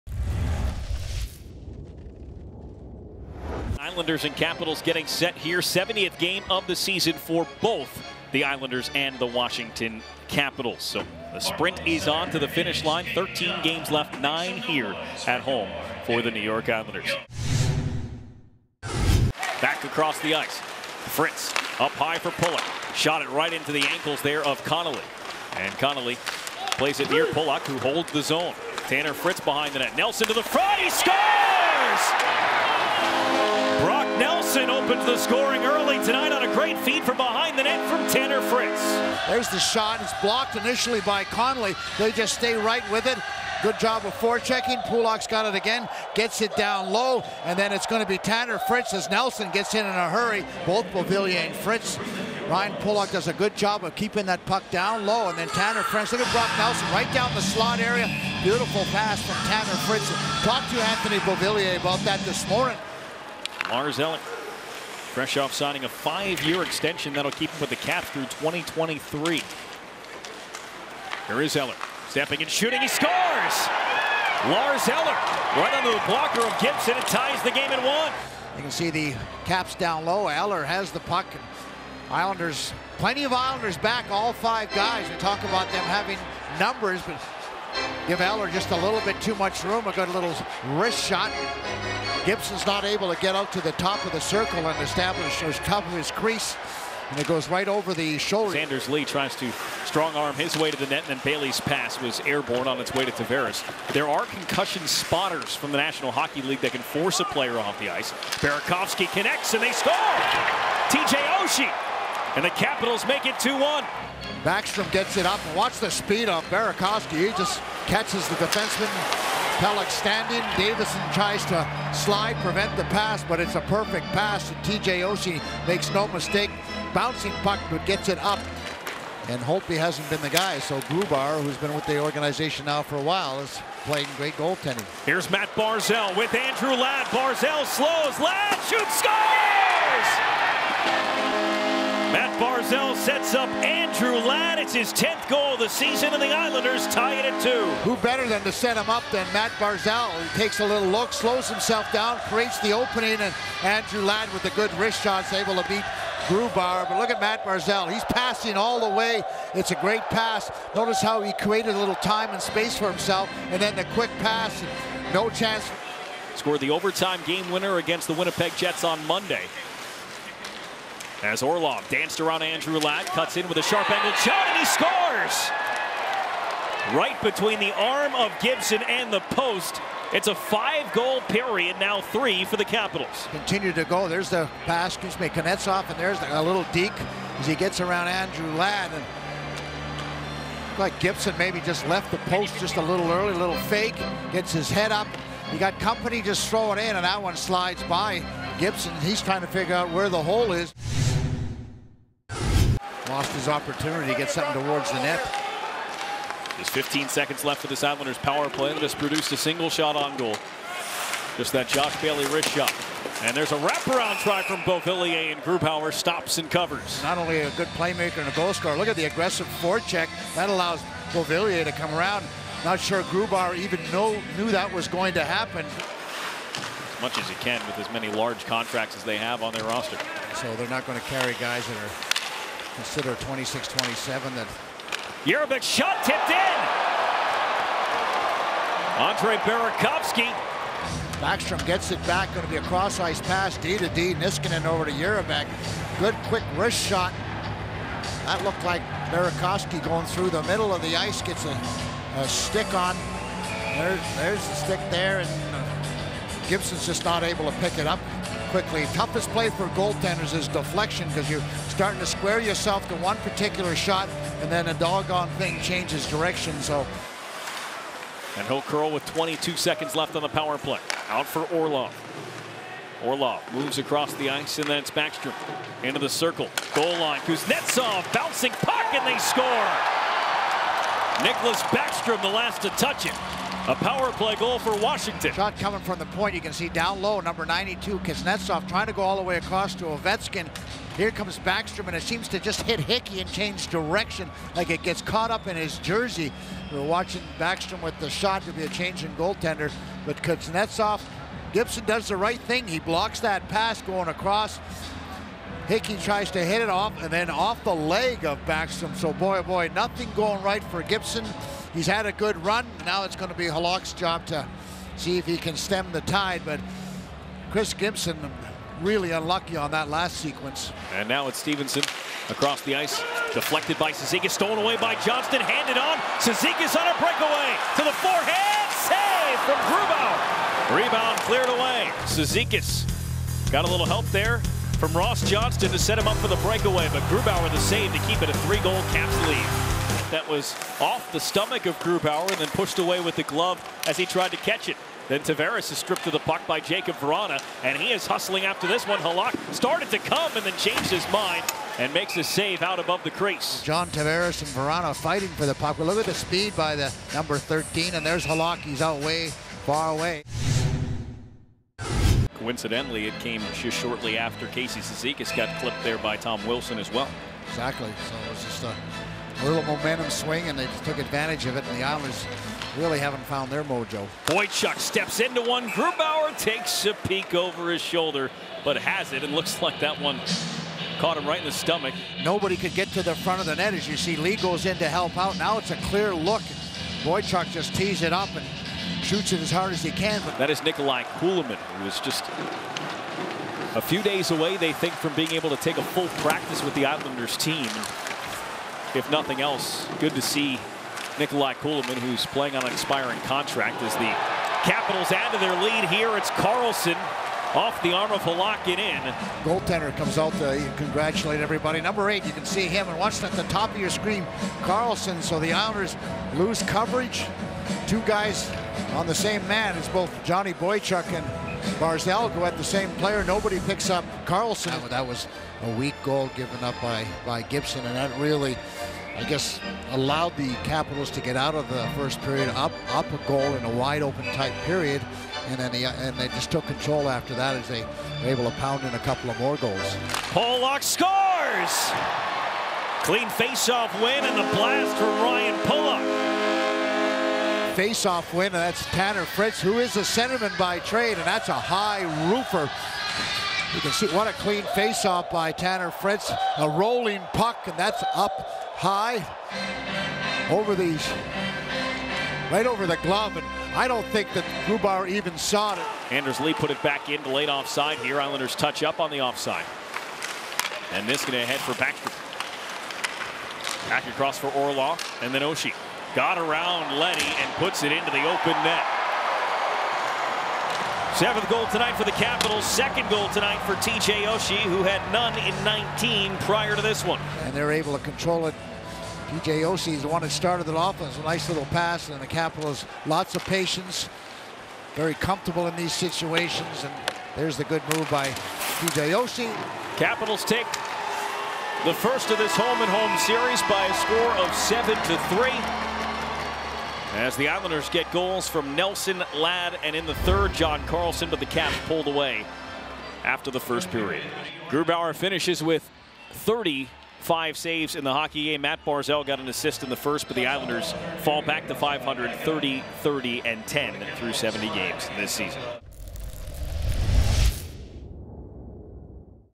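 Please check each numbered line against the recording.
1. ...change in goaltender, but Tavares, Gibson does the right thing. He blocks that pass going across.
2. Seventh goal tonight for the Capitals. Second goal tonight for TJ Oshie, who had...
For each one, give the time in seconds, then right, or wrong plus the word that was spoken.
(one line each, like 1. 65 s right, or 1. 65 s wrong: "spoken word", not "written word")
1. 298 s wrong: "Kuznetsov", not "Tavares"
2. 481 s right.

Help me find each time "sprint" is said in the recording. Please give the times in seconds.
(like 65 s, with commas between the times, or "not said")
11 s.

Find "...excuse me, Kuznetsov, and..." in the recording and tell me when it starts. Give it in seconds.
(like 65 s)
184 s.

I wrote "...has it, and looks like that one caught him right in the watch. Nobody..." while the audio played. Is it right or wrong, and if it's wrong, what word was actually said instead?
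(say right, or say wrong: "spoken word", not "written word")
wrong: "stomach", not "watch".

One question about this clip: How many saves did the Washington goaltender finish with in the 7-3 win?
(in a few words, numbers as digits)
35.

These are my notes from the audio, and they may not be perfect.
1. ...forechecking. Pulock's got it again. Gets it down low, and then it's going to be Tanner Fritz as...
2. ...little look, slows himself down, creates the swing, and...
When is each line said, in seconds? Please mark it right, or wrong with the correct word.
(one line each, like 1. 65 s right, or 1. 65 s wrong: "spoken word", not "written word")
1. 44 s right
2. 150 s wrong: "opening", not "swing".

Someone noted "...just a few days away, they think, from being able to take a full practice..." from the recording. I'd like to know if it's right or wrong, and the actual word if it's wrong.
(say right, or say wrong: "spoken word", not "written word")
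right.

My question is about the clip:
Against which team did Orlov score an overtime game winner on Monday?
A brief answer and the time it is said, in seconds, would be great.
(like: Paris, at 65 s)
Winnipeg Jets, at 168 s.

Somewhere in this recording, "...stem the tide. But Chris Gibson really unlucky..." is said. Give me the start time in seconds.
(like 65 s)
315 s.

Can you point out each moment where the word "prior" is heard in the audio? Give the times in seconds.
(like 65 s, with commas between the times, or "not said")
486 s.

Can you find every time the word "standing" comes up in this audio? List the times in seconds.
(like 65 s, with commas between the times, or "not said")
119 s.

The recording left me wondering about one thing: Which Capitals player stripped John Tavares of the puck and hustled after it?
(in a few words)
Jacob Vrana.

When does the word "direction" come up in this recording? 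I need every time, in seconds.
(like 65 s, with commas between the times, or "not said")
266 s, 293 s.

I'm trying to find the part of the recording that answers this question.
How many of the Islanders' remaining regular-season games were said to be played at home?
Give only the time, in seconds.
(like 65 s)
14 s.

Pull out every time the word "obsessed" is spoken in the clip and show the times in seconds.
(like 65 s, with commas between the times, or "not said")
not said.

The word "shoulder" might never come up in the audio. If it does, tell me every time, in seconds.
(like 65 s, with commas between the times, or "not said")
98 s, 377 s.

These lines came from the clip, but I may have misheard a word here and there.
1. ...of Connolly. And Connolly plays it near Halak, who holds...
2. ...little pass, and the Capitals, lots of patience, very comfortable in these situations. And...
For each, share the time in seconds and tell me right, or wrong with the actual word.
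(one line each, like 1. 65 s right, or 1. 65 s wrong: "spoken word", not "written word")
1. 24 s wrong: "Pulock", not "Halak"
2. 491 s right.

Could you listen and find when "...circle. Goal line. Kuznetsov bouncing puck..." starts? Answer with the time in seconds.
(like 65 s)
276 s.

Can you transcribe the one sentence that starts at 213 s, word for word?
And there's a wraparound try from Beauvillier, and Grubauer stops and covers.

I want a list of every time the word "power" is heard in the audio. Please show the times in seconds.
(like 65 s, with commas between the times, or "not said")
208 s, 270 s, 283 s.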